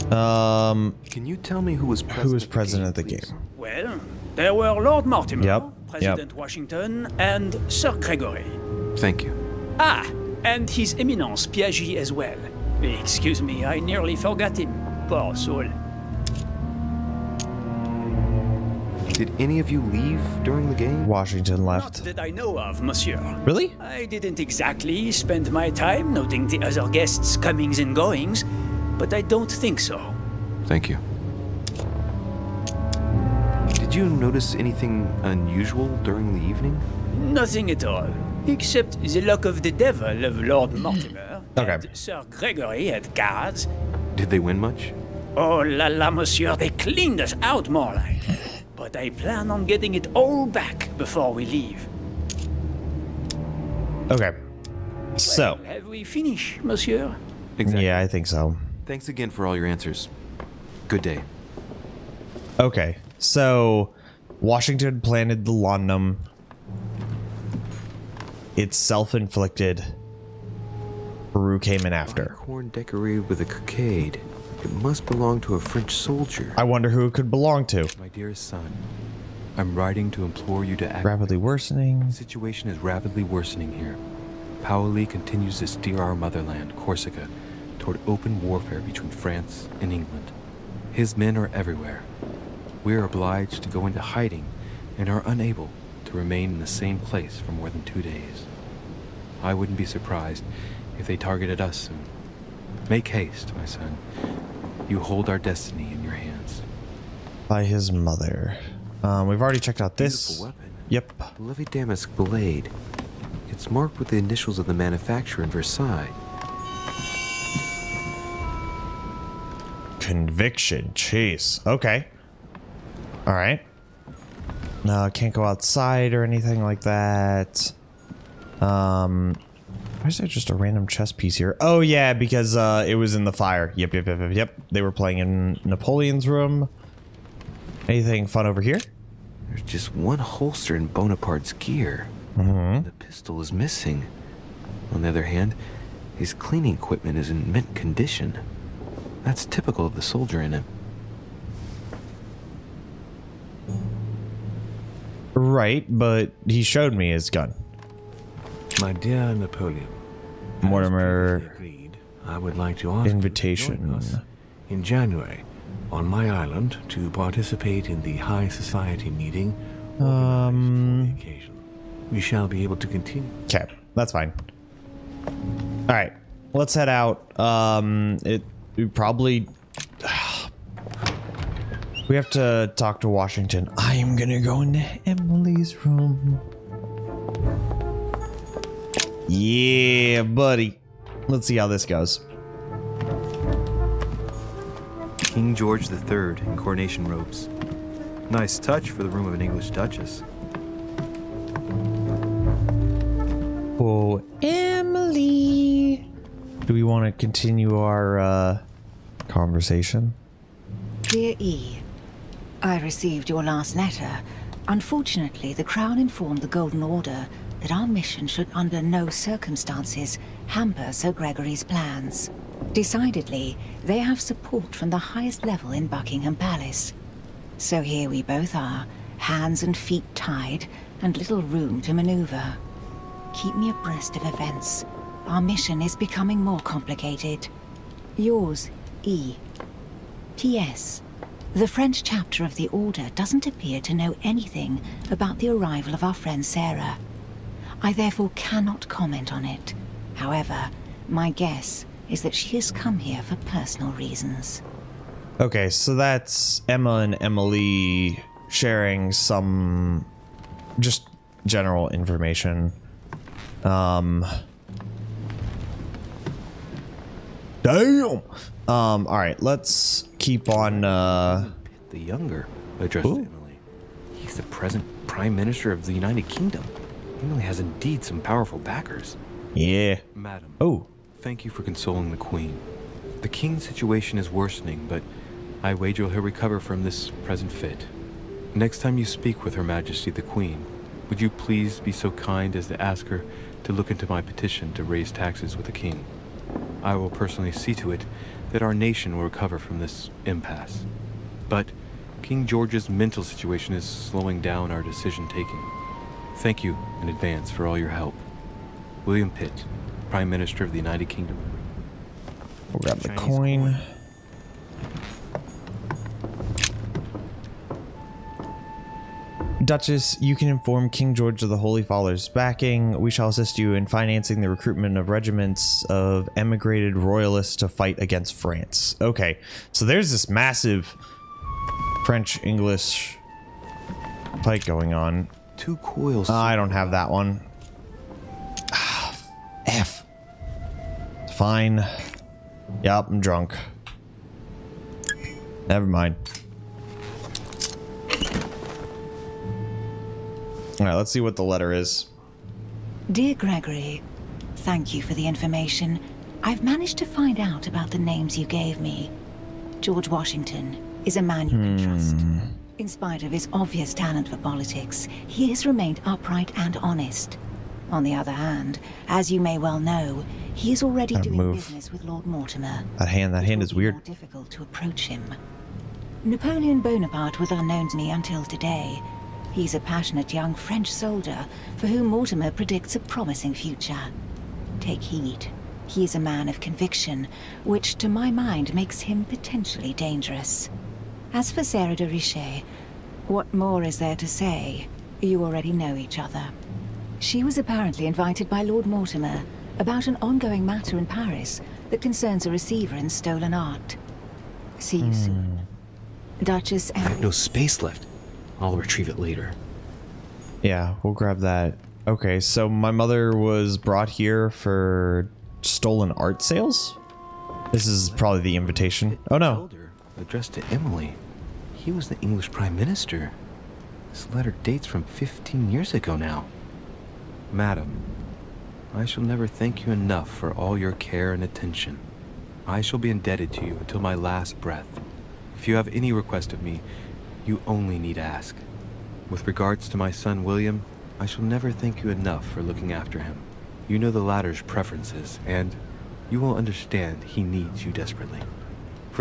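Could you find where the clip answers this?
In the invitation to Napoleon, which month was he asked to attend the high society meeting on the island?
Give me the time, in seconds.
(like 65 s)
164 s.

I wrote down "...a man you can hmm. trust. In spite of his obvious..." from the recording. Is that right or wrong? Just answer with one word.
right.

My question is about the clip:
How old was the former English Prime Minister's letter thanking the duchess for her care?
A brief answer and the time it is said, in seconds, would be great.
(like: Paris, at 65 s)
15, at 425 s.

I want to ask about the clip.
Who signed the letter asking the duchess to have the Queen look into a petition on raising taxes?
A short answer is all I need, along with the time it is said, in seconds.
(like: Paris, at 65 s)
William Pitt, at 309 s.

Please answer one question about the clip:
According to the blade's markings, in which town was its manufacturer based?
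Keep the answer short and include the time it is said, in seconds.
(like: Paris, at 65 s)
Versailles, at 115 s.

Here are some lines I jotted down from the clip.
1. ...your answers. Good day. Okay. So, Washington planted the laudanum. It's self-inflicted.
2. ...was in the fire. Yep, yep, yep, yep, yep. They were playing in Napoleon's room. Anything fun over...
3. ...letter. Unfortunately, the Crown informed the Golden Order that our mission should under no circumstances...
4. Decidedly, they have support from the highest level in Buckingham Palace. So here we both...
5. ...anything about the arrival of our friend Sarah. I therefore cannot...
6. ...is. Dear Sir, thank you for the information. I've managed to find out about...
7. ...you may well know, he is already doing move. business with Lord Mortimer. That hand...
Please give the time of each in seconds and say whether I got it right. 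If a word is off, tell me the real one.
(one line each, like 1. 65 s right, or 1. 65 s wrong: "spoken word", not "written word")
1. 59 s right
2. 132 s right
3. 213 s right
4. 222 s right
5. 244 s right
6. 351 s wrong: "Gregory", not "Sir"
7. 369 s right.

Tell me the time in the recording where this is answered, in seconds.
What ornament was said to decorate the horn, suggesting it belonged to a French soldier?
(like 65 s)
73 s.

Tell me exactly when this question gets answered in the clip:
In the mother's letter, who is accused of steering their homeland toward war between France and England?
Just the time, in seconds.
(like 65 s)
84 s.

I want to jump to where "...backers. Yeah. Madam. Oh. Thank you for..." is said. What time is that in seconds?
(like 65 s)
278 s.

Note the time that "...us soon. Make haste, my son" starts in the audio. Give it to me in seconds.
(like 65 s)
101 s.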